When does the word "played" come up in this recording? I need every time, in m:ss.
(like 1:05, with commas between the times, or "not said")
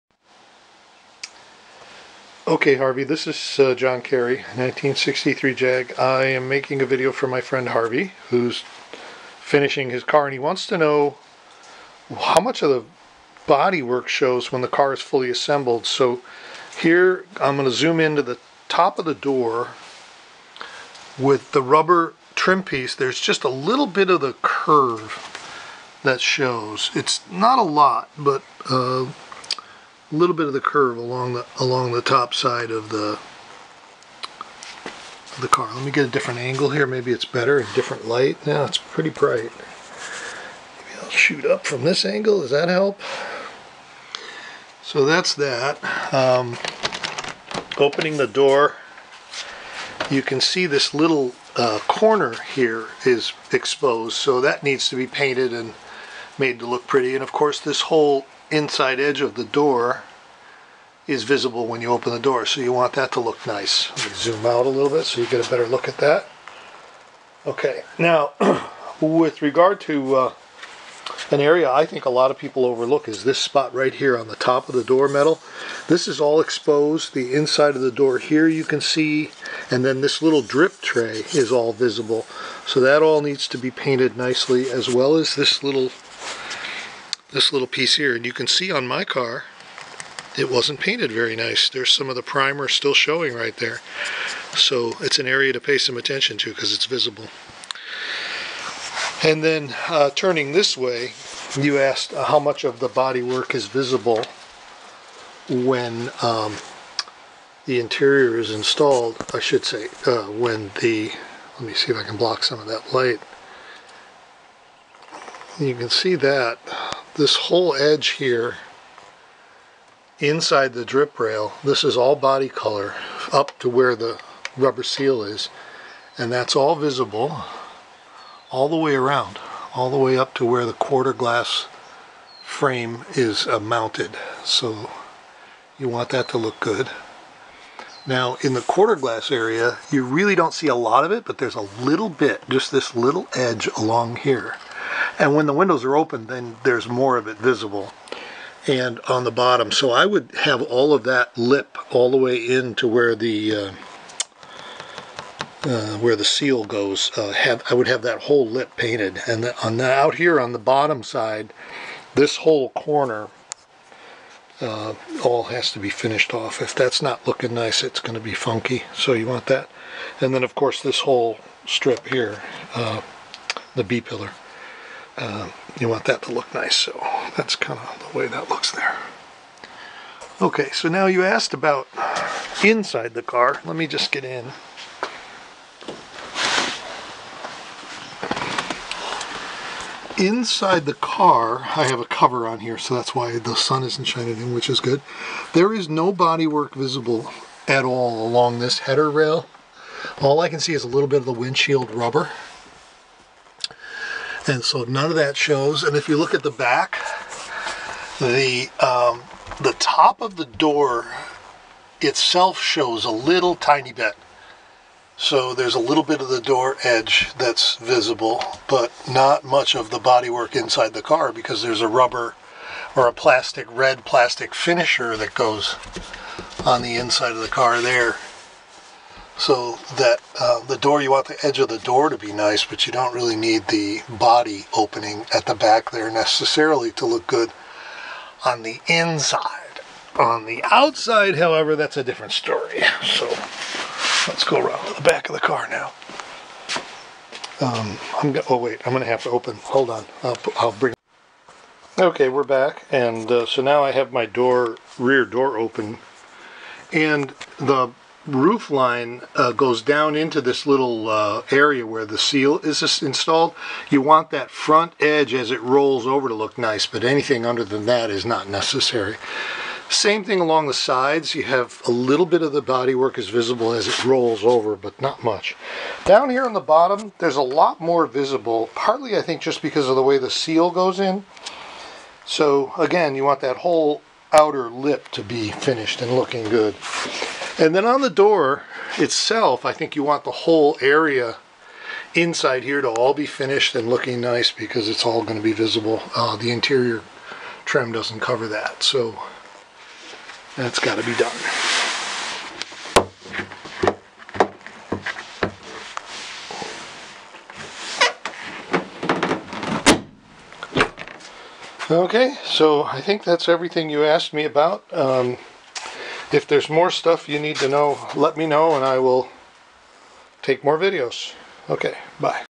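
not said.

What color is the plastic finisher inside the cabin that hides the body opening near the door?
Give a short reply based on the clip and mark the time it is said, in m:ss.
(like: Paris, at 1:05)
red, at 3:43.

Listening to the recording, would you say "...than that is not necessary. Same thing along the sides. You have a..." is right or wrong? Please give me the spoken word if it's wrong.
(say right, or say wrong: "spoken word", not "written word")
right.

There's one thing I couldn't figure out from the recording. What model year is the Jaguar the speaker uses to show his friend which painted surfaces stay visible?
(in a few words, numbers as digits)
1963.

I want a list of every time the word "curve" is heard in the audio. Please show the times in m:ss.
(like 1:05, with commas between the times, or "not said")
0:24, 0:30.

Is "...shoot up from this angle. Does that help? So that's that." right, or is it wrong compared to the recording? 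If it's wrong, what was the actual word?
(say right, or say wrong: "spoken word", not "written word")
right.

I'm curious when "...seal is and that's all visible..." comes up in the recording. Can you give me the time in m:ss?
2:04.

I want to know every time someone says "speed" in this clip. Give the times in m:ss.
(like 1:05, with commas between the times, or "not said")
not said.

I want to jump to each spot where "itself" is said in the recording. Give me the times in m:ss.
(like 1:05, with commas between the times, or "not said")
3:32, 4:48.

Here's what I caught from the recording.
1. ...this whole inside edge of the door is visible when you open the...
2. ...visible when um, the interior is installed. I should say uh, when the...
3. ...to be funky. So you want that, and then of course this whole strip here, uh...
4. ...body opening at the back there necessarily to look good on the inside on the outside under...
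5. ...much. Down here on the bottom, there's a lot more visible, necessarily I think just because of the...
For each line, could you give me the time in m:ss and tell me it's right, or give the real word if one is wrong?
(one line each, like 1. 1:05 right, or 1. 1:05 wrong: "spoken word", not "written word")
1. 0:57 right
2. 1:43 right
3. 2:48 right
4. 3:54 wrong: "however", not "under"
5. 4:35 wrong: "partly", not "necessarily".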